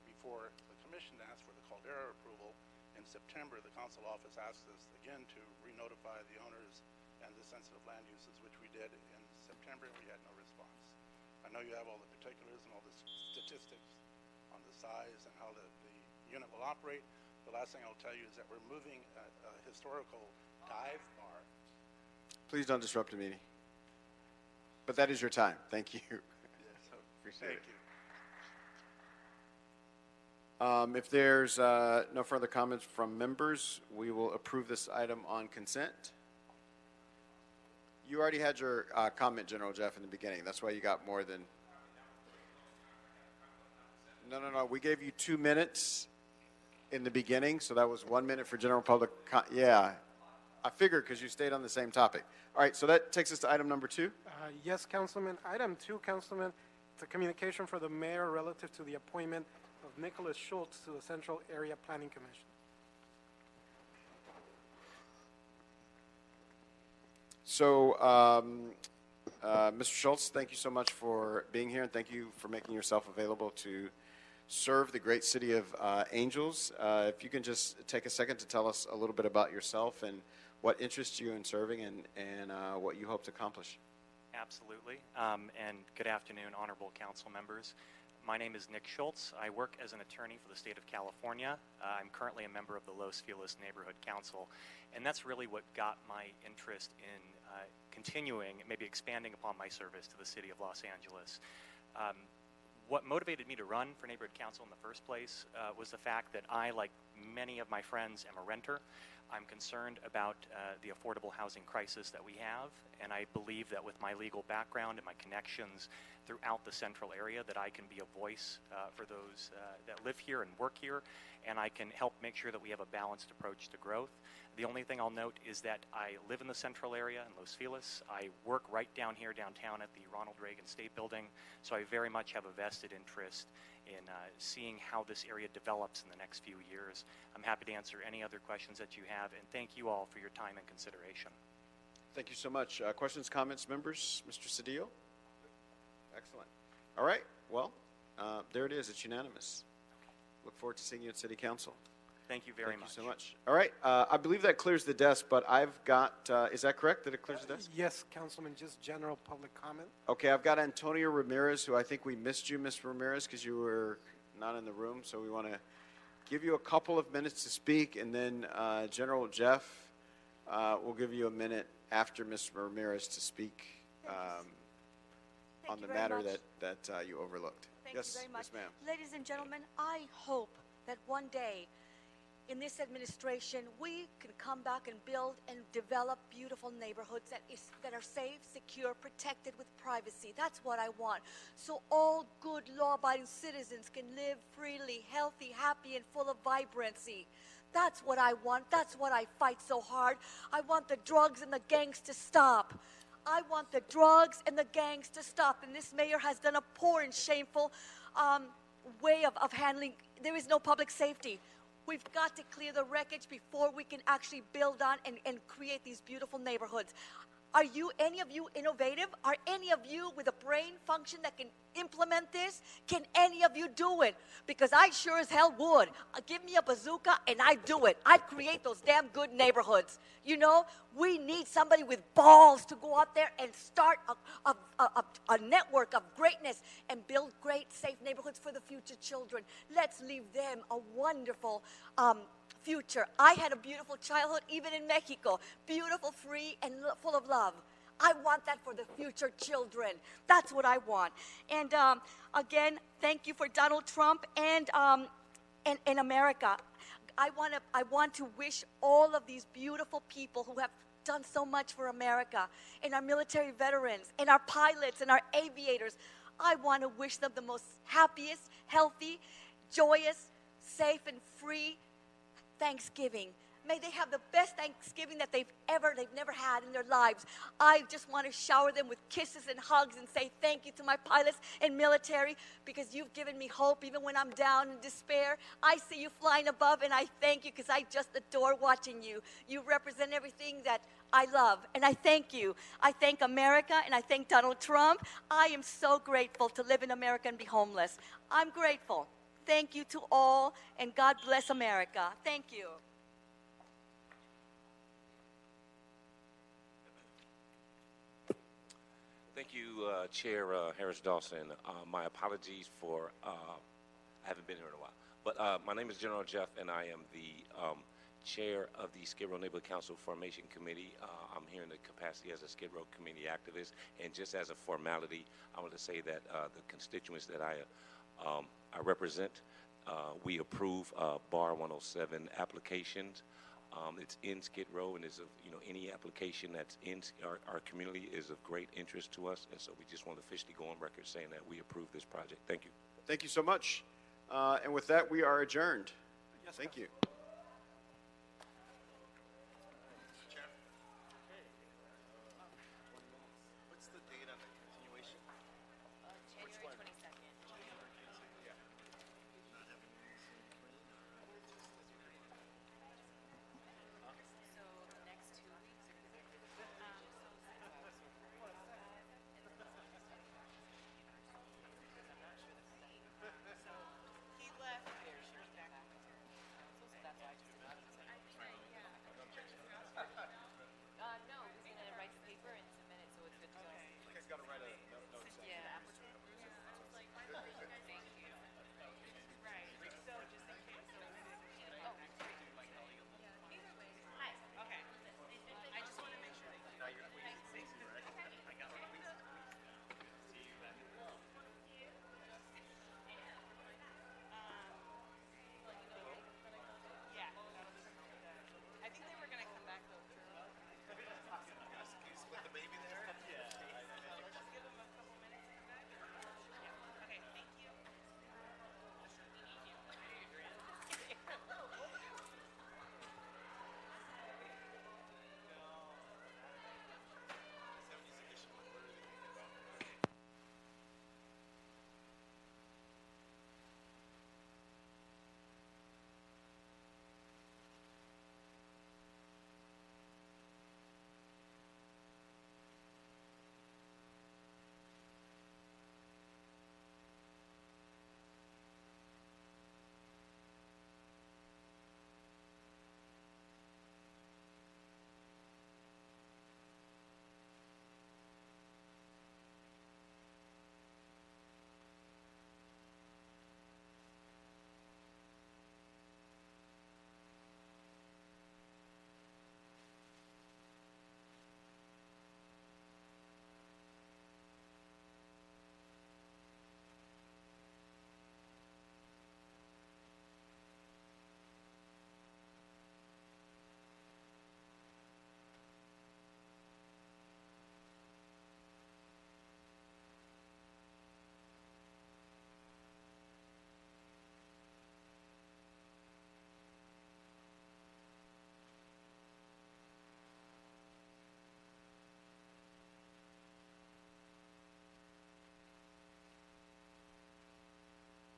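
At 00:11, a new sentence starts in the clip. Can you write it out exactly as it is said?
I know you have all the particulars and all the statistics on the size and how the, the unit will operate.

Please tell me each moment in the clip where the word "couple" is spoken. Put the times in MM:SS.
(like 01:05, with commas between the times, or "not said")
02:46.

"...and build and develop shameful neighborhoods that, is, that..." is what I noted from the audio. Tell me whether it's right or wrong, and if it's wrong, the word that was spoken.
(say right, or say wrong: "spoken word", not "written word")
wrong: "beautiful", not "shameful".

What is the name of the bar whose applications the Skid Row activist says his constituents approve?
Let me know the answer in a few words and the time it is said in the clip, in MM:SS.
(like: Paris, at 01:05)
Bar 107, at 05:31.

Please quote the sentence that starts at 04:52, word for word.
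I thank America and I thank Donald Trump.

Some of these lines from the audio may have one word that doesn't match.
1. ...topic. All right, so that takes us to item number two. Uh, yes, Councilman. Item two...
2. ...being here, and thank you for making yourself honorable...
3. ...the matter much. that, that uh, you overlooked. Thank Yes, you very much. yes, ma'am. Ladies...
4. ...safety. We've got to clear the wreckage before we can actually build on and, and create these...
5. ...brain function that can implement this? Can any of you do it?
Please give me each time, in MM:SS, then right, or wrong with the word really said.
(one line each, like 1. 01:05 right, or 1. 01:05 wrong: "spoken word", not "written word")
1. 00:51 right
2. 01:11 wrong: "available", not "honorable"
3. 02:55 right
4. 03:30 right
5. 03:40 right.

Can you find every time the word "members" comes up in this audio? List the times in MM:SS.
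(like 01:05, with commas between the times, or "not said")
00:33, 01:27, 01:32, 02:23.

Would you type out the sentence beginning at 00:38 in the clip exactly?
You already had your uh, comment, General Jeff, in the beginning.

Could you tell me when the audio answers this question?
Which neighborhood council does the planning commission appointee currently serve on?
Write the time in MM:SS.
01:32.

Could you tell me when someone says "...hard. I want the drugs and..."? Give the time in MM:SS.
03:19.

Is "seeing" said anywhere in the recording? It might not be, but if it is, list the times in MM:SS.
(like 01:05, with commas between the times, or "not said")
02:14, 02:30.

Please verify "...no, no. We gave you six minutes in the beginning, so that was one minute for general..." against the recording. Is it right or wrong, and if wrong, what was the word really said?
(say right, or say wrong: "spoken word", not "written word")
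wrong: "two", not "six".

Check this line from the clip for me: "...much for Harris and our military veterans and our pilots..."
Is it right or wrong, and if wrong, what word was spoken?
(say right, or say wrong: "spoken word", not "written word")
wrong: "America", not "Harris".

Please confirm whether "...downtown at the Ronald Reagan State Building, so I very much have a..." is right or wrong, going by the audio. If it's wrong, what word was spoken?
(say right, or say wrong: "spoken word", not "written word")
right.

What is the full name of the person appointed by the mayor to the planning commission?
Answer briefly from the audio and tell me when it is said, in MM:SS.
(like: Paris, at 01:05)
Nicholas Schultz, at 00:59.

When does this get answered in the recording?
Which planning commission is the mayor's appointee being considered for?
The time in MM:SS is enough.
01:01.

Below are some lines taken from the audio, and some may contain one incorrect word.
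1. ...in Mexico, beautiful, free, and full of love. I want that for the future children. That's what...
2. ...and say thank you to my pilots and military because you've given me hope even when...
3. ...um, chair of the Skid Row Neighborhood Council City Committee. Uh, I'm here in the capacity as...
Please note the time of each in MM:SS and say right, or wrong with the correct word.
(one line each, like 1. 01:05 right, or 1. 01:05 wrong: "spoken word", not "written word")
1. 04:04 right
2. 04:39 right
3. 05:17 wrong: "Formation", not "City".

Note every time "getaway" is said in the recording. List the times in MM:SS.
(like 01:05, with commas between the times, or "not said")
not said.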